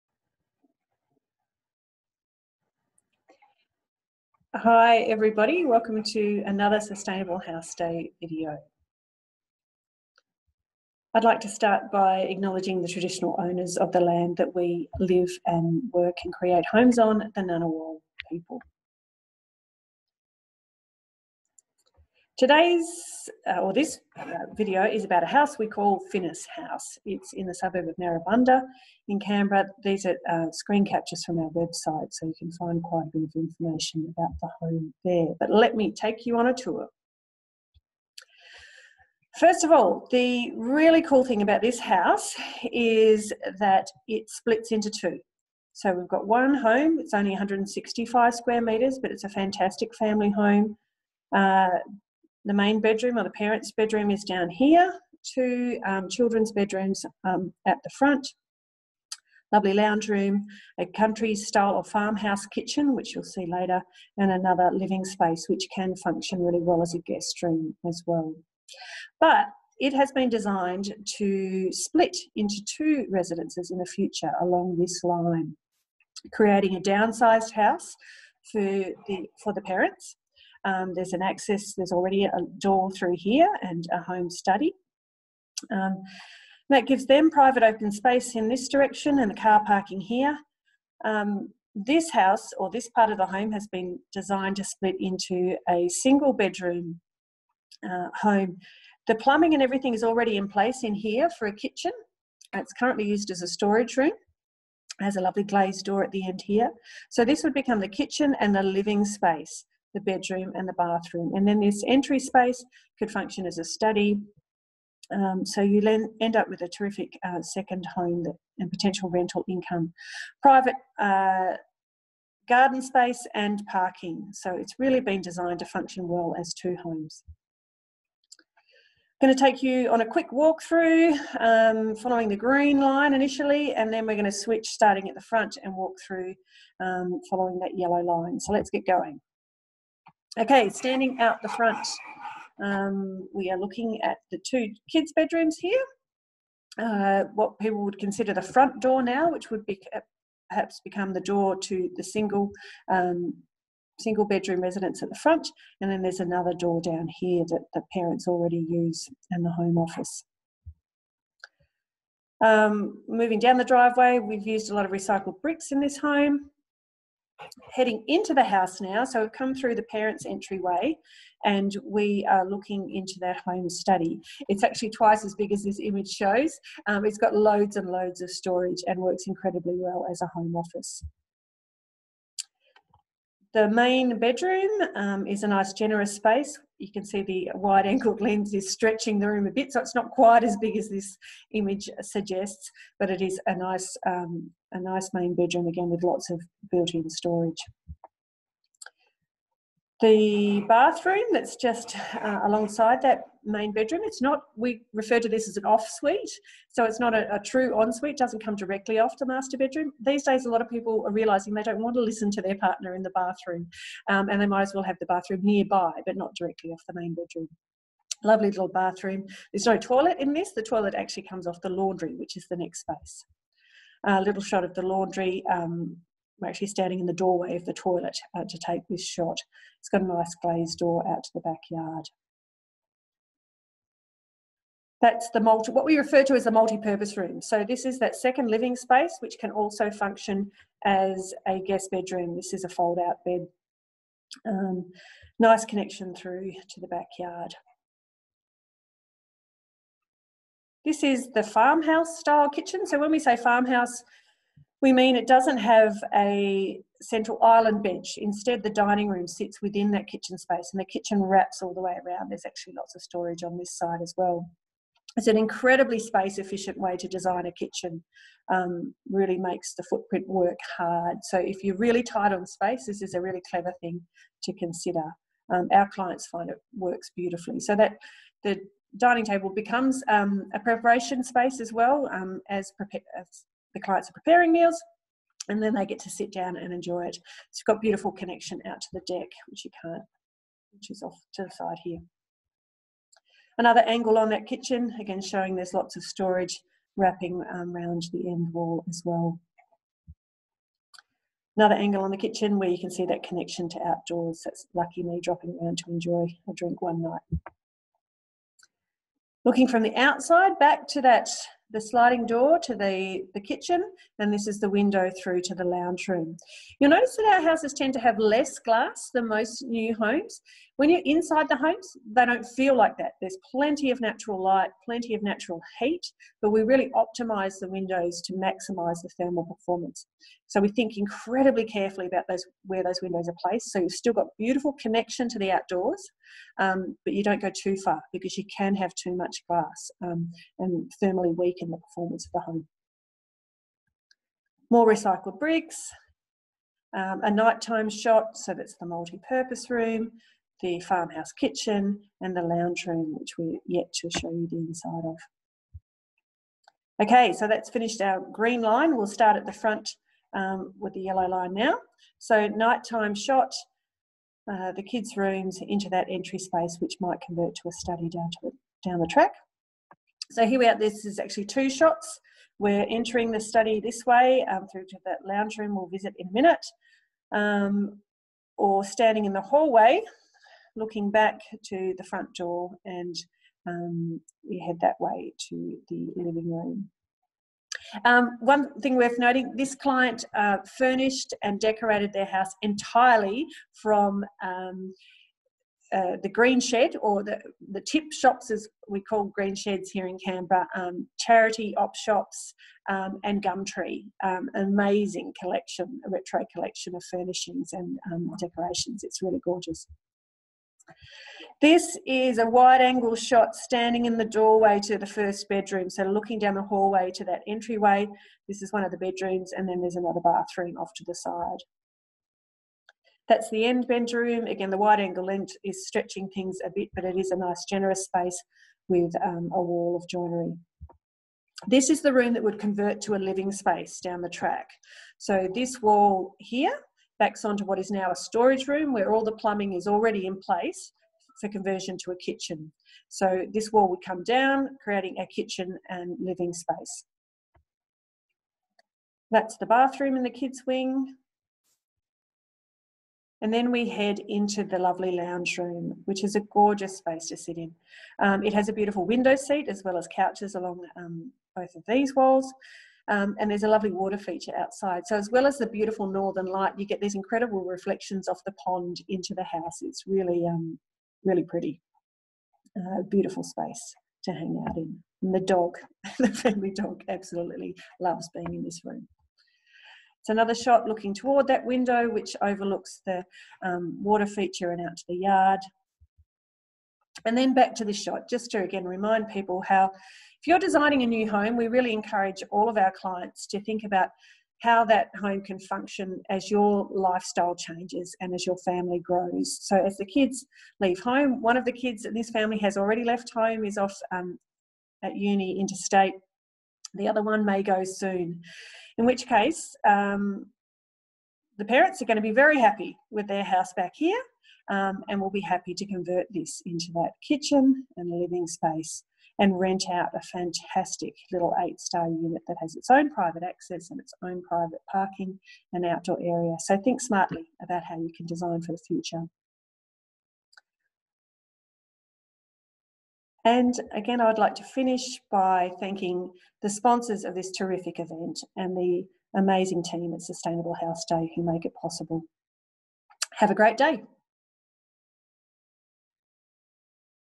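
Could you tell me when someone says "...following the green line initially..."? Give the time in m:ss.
2:11.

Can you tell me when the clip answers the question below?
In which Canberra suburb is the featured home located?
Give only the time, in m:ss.
0:27.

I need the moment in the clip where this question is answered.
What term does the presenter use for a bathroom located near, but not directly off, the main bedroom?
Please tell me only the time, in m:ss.
3:25.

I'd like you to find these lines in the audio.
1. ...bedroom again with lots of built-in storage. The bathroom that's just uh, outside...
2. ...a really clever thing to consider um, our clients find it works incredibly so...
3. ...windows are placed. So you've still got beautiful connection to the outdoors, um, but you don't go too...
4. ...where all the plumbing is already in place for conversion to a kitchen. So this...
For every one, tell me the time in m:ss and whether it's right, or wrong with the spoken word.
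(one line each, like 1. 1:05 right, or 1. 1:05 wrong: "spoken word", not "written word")
1. 3:15 wrong: "alongside", not "outside"
2. 4:33 wrong: "beautifully", not "incredibly"
3. 5:33 right
4. 7:18 right.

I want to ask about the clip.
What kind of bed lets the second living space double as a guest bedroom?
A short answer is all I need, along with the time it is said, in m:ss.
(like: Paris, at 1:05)
fold-out bed, at 4:02.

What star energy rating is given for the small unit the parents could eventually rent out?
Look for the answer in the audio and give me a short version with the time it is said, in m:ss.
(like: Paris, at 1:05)
8 star, at 8:41.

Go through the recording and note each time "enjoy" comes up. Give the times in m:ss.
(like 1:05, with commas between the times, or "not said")
4:46, 5:05.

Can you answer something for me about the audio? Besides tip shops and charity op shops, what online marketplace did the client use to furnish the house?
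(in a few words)
Gumtree.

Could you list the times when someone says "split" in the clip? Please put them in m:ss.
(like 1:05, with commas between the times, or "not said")
0:44, 1:11, 1:34.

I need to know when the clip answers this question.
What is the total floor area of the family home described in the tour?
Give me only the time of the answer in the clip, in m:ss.
0:47.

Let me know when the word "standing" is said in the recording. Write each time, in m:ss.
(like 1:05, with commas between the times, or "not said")
2:20, 3:46, 6:18, 6:53.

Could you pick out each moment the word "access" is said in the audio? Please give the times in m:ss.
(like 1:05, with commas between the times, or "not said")
1:21, 8:43.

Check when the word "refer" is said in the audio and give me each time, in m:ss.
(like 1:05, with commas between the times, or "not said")
3:24, 3:55.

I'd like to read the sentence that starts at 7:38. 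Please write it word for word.
Um, it has a beautiful window seat as well as couches along um, both of these walls.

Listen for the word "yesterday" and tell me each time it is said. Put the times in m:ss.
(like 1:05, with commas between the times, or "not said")
not said.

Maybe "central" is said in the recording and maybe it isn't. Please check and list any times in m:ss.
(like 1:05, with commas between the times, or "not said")
4:17.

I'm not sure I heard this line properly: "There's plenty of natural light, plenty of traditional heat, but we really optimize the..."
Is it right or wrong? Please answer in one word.
wrong.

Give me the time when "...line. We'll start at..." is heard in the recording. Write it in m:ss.
5:58.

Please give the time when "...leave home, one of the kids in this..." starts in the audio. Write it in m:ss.
8:20.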